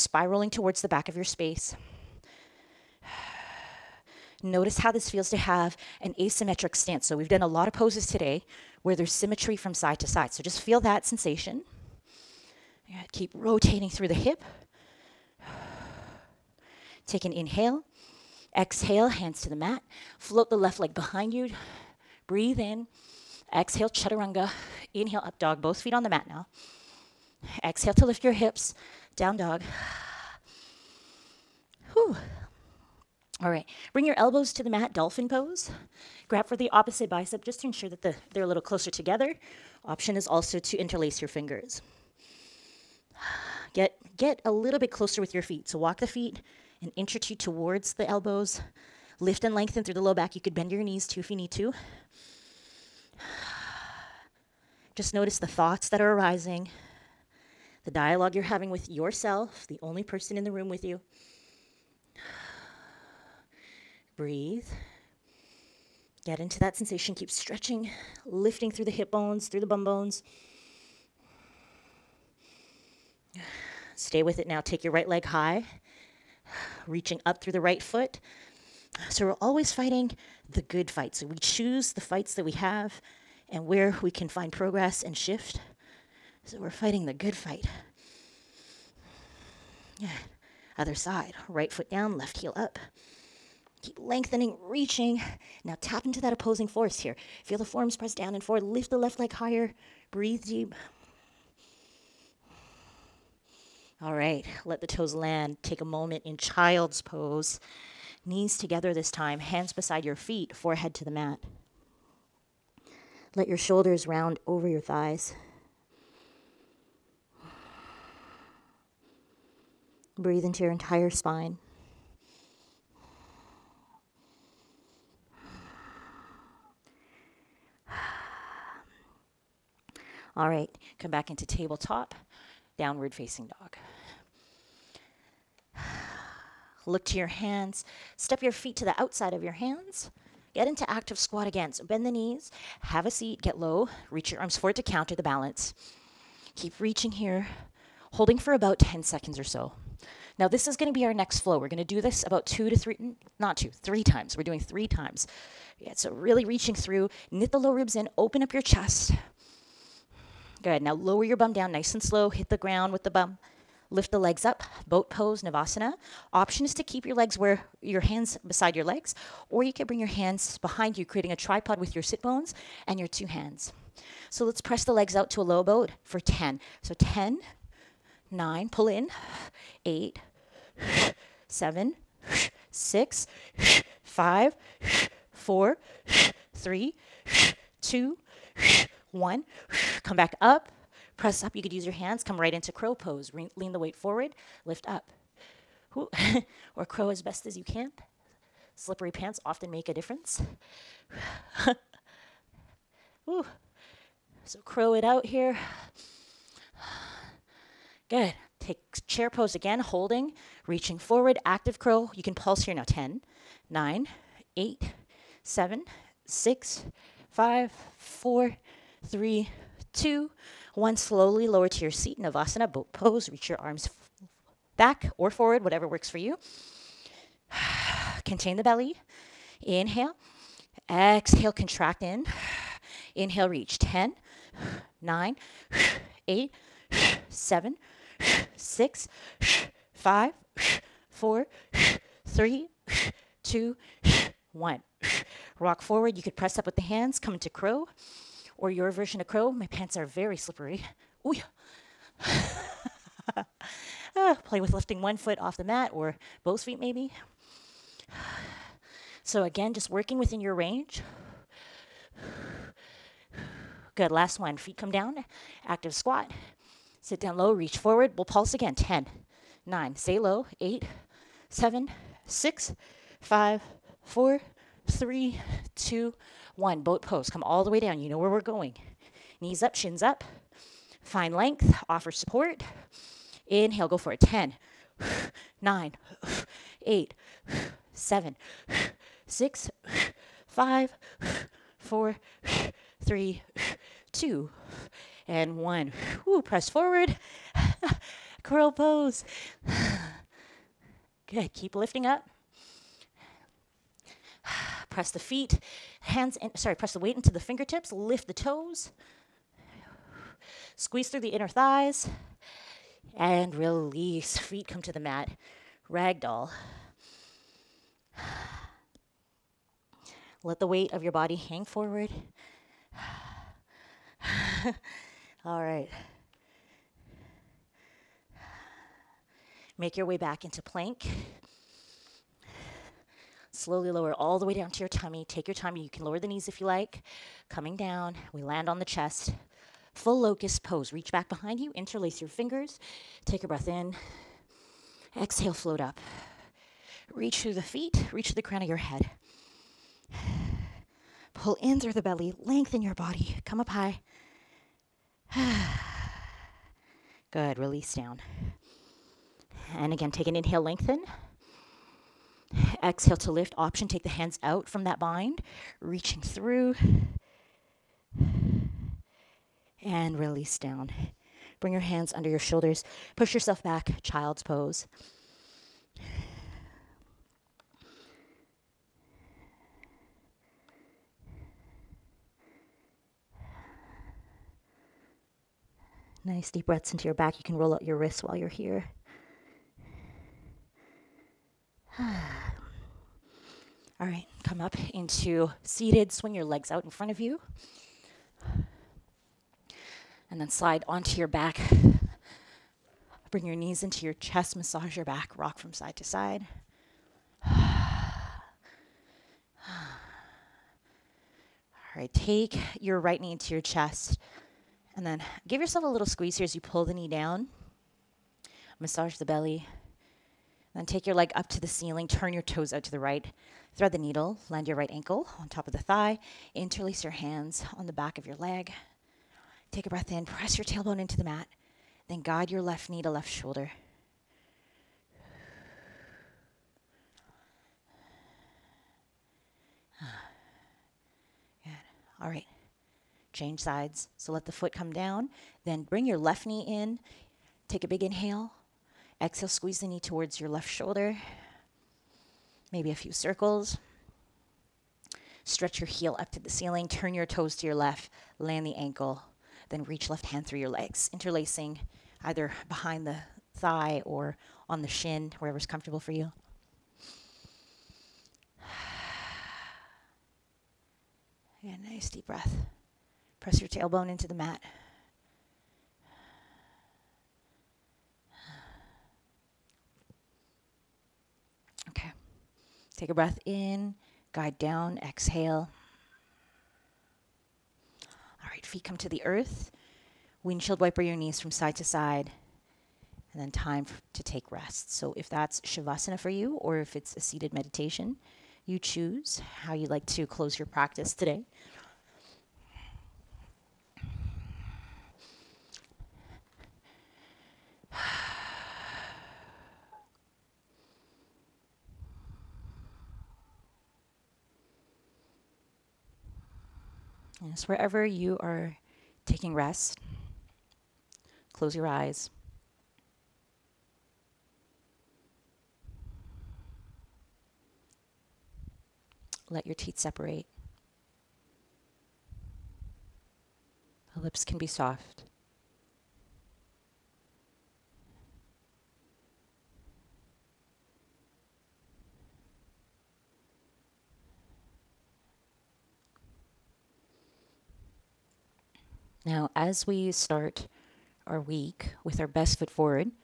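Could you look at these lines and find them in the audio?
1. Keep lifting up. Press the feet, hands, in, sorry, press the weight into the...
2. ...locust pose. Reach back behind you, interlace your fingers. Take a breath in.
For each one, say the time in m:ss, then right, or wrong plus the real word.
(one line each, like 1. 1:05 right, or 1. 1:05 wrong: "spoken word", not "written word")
1. 5:01 right
2. 5:40 right.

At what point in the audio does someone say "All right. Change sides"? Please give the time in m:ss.
7:22.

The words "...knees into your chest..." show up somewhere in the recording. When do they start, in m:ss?
6:43.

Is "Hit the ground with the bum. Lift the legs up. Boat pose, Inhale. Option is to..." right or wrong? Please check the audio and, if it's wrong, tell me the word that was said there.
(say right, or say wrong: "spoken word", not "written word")
wrong: "Navasana", not "Inhale".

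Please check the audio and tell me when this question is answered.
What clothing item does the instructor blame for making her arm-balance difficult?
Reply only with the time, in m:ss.
3:18.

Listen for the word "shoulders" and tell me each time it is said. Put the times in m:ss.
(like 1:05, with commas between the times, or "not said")
1:53, 6:12, 7:13, 7:30.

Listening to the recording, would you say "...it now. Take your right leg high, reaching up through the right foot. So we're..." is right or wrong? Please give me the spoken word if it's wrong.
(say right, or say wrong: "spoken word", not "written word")
right.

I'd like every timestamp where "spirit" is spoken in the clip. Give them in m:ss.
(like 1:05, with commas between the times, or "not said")
not said.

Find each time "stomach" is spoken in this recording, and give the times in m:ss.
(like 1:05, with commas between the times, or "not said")
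not said.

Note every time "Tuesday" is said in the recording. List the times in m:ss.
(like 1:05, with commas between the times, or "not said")
not said.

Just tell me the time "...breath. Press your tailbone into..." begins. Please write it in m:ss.
7:52.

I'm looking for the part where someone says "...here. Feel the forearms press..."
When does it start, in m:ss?
1:36.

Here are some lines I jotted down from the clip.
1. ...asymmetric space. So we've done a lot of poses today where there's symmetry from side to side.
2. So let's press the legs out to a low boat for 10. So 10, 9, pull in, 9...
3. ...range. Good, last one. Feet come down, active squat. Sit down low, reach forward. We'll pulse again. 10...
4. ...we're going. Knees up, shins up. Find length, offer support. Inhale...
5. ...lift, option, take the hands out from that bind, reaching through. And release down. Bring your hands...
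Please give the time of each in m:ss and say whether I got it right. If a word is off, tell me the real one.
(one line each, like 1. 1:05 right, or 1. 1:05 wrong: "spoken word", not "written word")
1. 0:06 wrong: "stance", not "space"
2. 2:54 wrong: "8", not "9"
3. 4:20 right
4. 4:38 right
5. 6:03 right.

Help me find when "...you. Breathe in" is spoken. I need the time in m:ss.
0:21.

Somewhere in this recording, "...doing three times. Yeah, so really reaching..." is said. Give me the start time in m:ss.
2:34.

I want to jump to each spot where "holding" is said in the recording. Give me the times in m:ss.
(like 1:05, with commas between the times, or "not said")
2:28, 3:29.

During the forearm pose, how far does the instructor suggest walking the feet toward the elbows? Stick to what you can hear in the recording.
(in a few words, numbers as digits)
An inch or two.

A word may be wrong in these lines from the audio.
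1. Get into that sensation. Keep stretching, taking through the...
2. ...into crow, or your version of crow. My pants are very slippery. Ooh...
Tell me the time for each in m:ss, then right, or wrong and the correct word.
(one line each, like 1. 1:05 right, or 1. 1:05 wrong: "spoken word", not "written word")
1. 1:06 wrong: "lifting", not "taking"
2. 4:07 right.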